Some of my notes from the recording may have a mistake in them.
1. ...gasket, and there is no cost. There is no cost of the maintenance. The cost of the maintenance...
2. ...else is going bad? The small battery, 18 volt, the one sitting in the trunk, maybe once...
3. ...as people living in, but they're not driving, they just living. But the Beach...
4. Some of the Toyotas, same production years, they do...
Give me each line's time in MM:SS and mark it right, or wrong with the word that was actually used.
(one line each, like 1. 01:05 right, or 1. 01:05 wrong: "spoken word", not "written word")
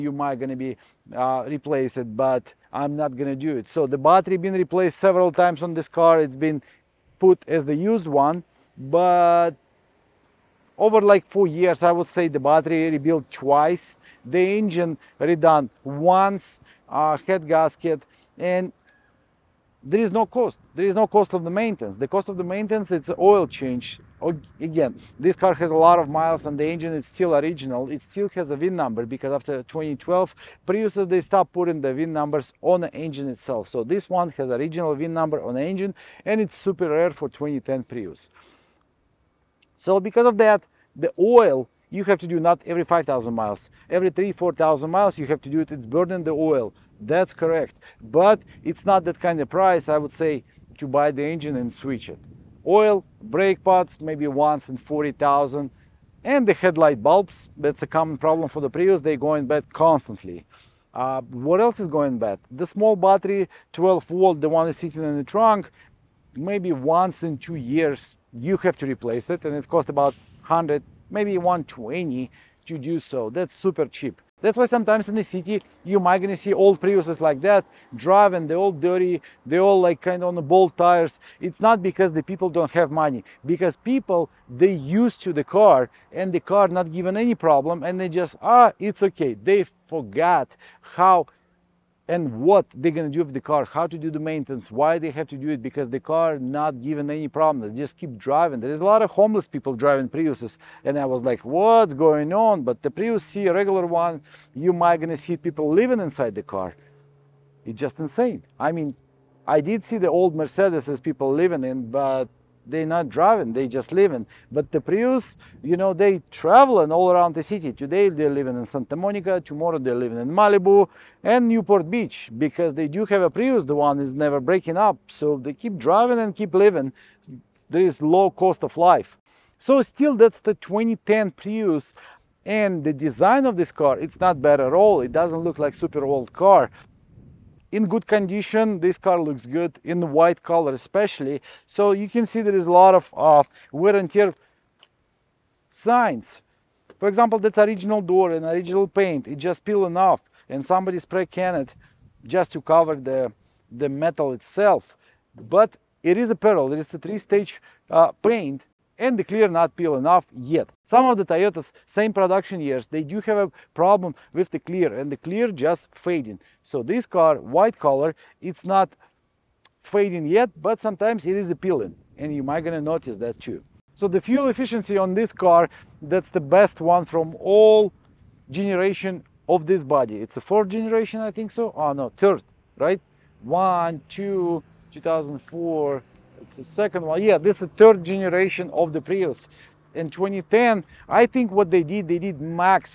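1. 00:17 right
2. 01:01 wrong: "12", not "18"
3. 01:50 wrong: "Prius", not "Beach"
4. 02:40 right.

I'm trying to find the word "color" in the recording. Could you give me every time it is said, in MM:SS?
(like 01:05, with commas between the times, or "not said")
02:20, 02:47.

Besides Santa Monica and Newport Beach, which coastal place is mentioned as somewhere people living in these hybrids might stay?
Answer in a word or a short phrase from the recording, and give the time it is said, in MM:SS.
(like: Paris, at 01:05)
Malibu, at 02:00.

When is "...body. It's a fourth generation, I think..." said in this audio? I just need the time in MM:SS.
02:59.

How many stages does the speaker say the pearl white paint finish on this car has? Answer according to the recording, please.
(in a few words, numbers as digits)
3.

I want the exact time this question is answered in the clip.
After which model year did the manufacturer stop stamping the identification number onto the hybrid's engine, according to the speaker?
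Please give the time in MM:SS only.
00:29.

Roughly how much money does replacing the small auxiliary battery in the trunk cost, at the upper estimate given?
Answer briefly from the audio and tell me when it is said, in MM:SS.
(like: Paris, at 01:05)
120, at 01:11.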